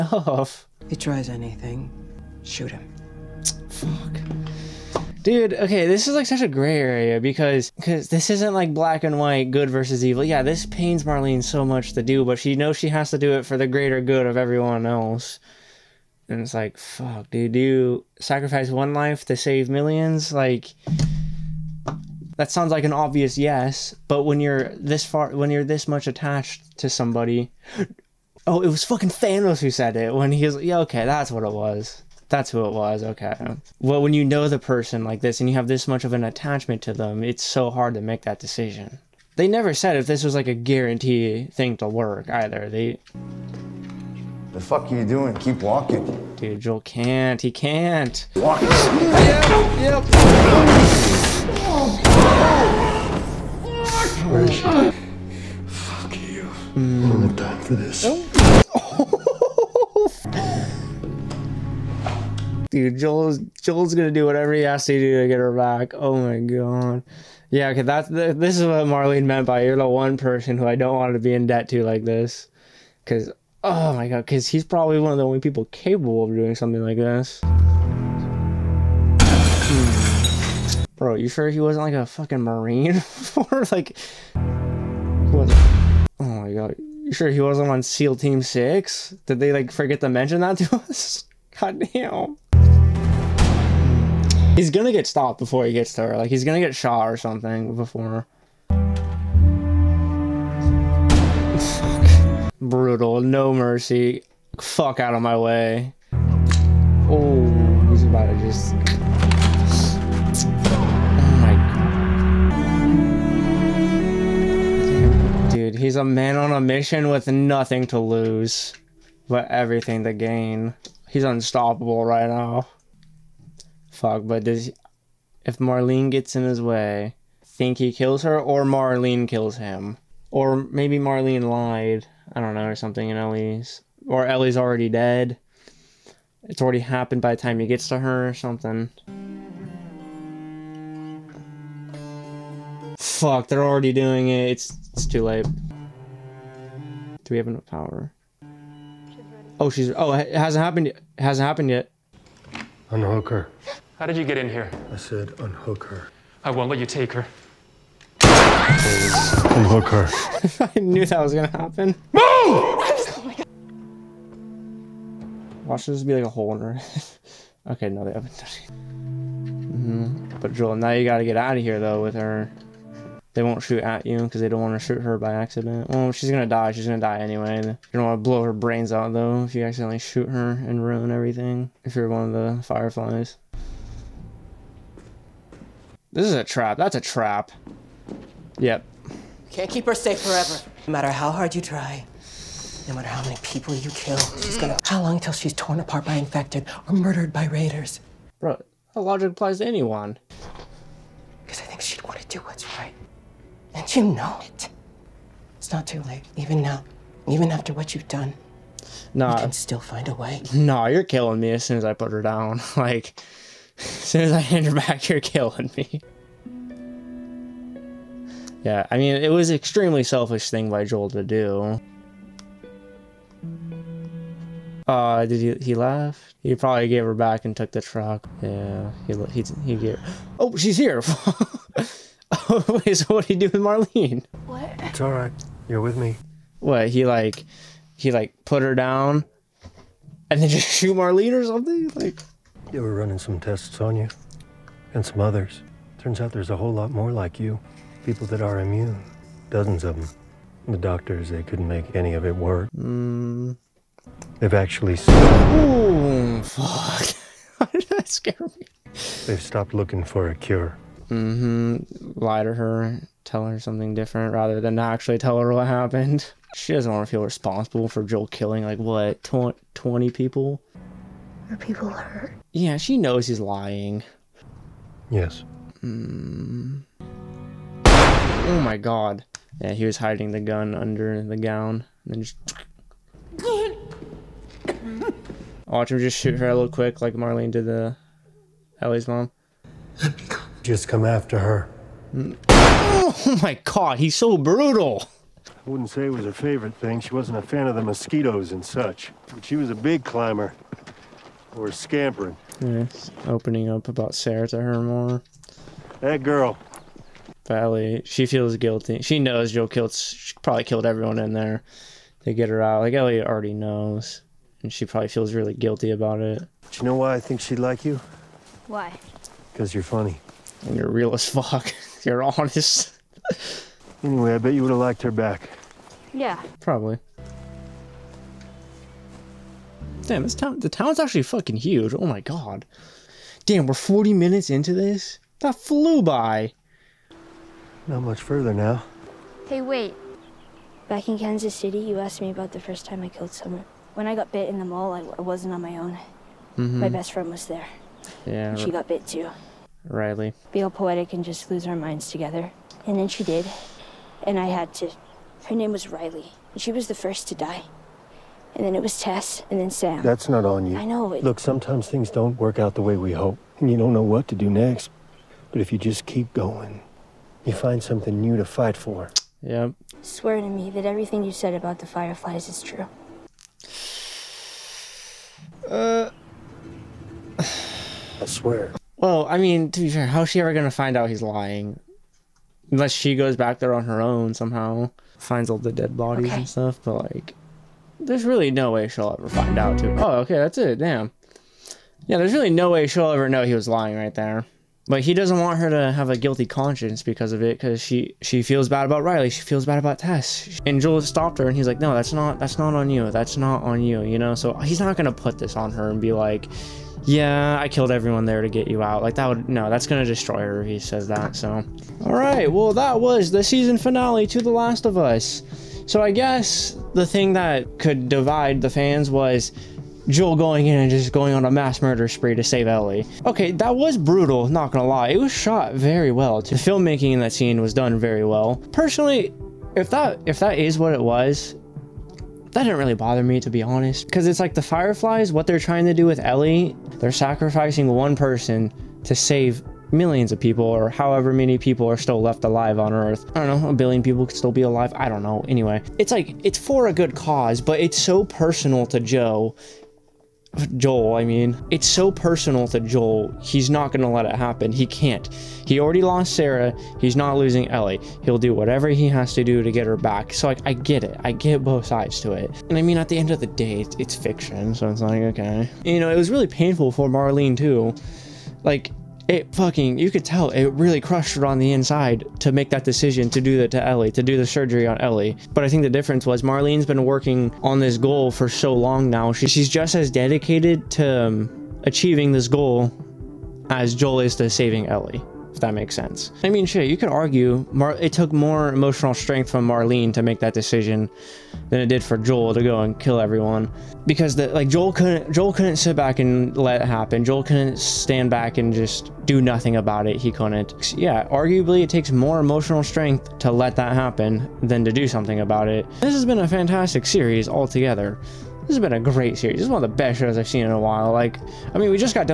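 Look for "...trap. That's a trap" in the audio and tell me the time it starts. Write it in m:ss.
3:06.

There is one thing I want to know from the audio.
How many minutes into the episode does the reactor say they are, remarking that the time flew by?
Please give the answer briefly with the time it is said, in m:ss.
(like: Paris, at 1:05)
40, at 5:33.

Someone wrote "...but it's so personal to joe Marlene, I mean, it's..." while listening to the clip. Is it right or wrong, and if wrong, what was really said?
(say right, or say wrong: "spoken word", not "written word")
wrong: "Joel", not "Marlene".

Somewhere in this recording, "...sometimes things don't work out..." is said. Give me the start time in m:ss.
6:01.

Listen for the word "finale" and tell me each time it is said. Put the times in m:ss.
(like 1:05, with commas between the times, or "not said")
6:53.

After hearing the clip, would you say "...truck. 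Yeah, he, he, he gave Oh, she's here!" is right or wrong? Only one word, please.
right.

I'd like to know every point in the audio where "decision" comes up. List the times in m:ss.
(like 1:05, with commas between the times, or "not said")
0:38, 7:52, 8:10.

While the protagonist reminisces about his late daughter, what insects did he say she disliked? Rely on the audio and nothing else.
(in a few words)
mosquitoes.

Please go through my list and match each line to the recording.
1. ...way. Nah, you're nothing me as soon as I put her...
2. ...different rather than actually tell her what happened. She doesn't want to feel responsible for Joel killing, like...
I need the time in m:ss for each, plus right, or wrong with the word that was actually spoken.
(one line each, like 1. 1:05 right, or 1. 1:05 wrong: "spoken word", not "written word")
1. 3:30 wrong: "killing", not "nothing"
2. 4:23 right.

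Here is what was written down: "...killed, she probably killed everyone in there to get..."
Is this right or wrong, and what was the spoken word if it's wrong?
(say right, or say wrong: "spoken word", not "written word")
right.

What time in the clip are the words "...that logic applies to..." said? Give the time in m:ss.
3:18.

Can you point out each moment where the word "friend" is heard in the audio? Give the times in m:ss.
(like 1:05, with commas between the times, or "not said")
5:47.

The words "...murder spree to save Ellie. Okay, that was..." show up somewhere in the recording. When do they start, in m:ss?
7:01.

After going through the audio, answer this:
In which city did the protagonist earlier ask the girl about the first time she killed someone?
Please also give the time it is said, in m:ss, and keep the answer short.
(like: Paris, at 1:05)
Kansas City, at 5:41.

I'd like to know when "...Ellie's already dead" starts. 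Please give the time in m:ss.
2:14.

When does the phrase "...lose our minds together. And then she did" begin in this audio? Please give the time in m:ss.
5:51.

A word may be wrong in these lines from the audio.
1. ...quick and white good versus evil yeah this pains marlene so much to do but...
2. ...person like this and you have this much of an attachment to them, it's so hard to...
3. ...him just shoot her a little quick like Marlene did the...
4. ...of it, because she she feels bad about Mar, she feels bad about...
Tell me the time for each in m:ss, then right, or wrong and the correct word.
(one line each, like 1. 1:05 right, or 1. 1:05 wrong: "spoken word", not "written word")
1. 0:08 wrong: "black", not "quick"
2. 0:34 right
3. 4:45 right
4. 6:37 wrong: "Riley", not "Mar".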